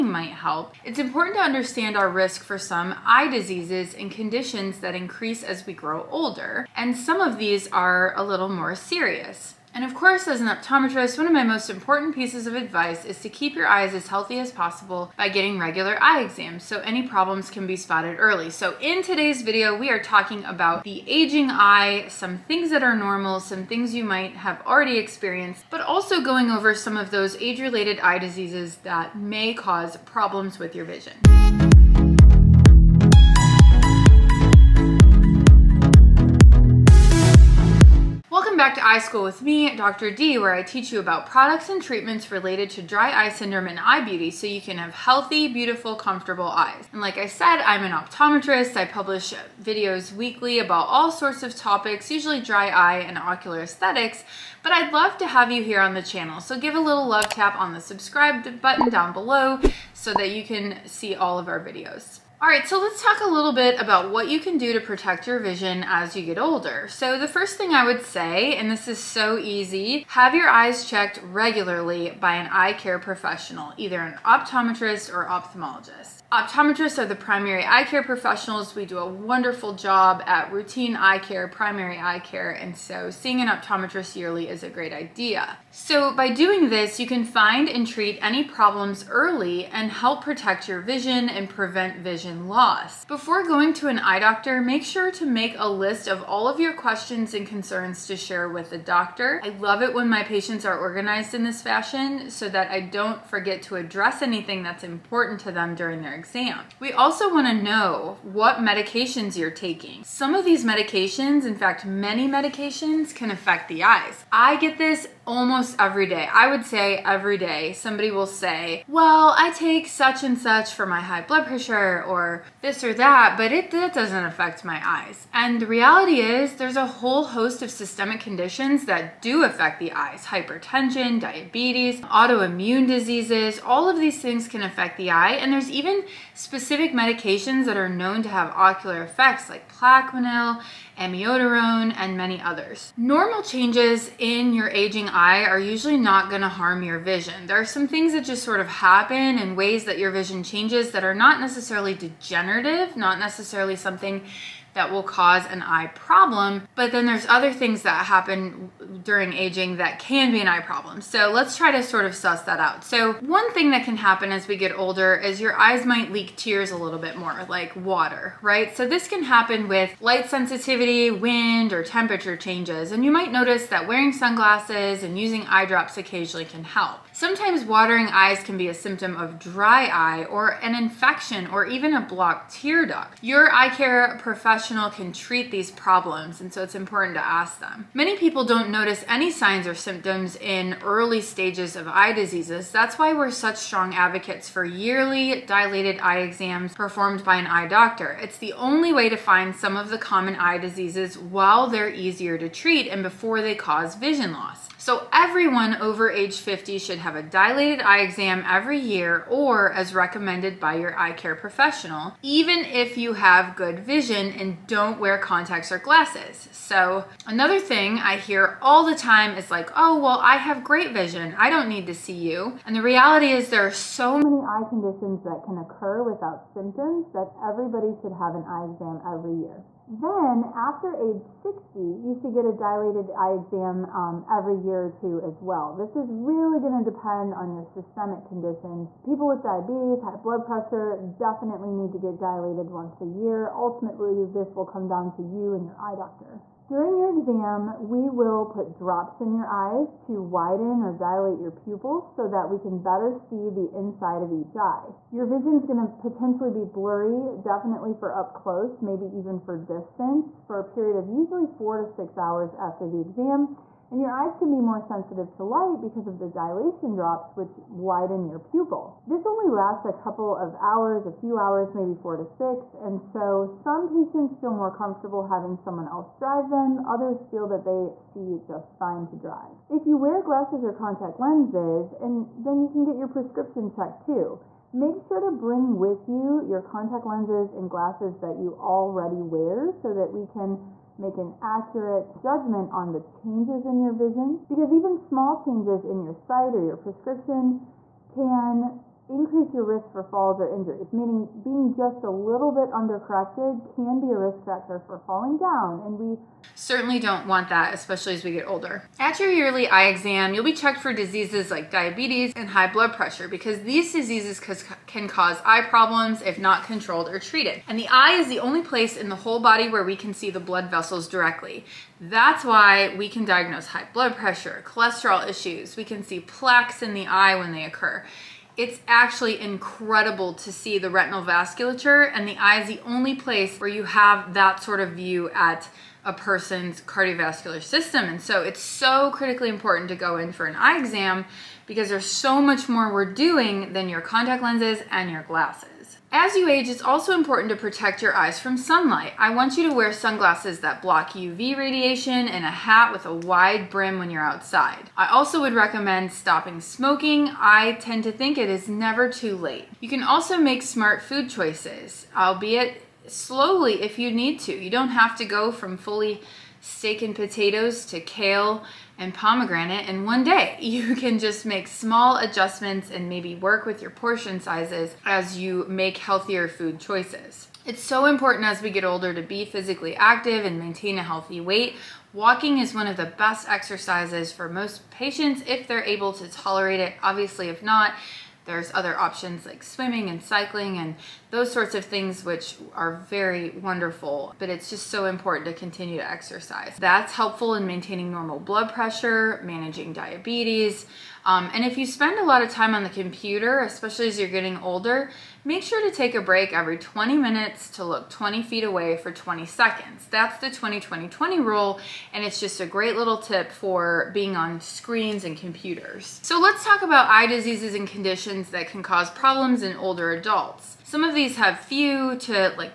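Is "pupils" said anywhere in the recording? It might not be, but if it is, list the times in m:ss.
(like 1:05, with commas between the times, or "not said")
4:11, 4:28.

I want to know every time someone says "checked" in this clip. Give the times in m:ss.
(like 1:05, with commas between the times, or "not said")
1:10, 4:43, 5:10.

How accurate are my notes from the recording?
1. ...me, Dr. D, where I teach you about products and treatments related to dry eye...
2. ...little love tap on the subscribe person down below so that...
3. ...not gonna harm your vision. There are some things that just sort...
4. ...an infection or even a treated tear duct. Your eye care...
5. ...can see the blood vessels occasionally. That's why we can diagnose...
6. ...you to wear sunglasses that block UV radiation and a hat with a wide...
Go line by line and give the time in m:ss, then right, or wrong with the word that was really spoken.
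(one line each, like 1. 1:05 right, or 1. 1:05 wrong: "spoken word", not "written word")
1. 0:39 right
2. 0:56 wrong: "button", not "person"
3. 2:25 right
4. 3:00 wrong: "blocked", not "treated"
5. 5:19 wrong: "directly", not "occasionally"
6. 5:49 right.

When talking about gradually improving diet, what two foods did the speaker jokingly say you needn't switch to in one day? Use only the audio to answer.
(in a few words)
kale and pomegranate.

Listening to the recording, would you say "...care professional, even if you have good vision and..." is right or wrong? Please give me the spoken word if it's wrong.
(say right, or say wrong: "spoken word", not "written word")
right.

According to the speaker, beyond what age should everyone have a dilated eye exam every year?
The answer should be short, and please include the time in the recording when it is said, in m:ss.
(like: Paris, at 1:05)
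50, at 3:26.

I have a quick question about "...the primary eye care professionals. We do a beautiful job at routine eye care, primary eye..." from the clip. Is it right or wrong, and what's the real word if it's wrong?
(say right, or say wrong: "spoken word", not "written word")
wrong: "wonderful", not "beautiful".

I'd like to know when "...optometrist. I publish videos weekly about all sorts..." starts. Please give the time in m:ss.
0:47.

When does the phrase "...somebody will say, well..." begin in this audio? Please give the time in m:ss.
1:57.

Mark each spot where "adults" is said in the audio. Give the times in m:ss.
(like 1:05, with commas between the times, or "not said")
7:00.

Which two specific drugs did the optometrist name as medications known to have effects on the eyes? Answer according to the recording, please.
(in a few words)
Plaquenil, amiodarone.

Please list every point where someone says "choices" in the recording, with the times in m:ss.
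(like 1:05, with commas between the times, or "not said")
6:01, 6:16.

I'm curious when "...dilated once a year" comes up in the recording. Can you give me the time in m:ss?
4:02.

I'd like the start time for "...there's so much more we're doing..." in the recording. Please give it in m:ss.
5:41.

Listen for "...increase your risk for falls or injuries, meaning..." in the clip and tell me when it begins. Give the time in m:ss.
4:59.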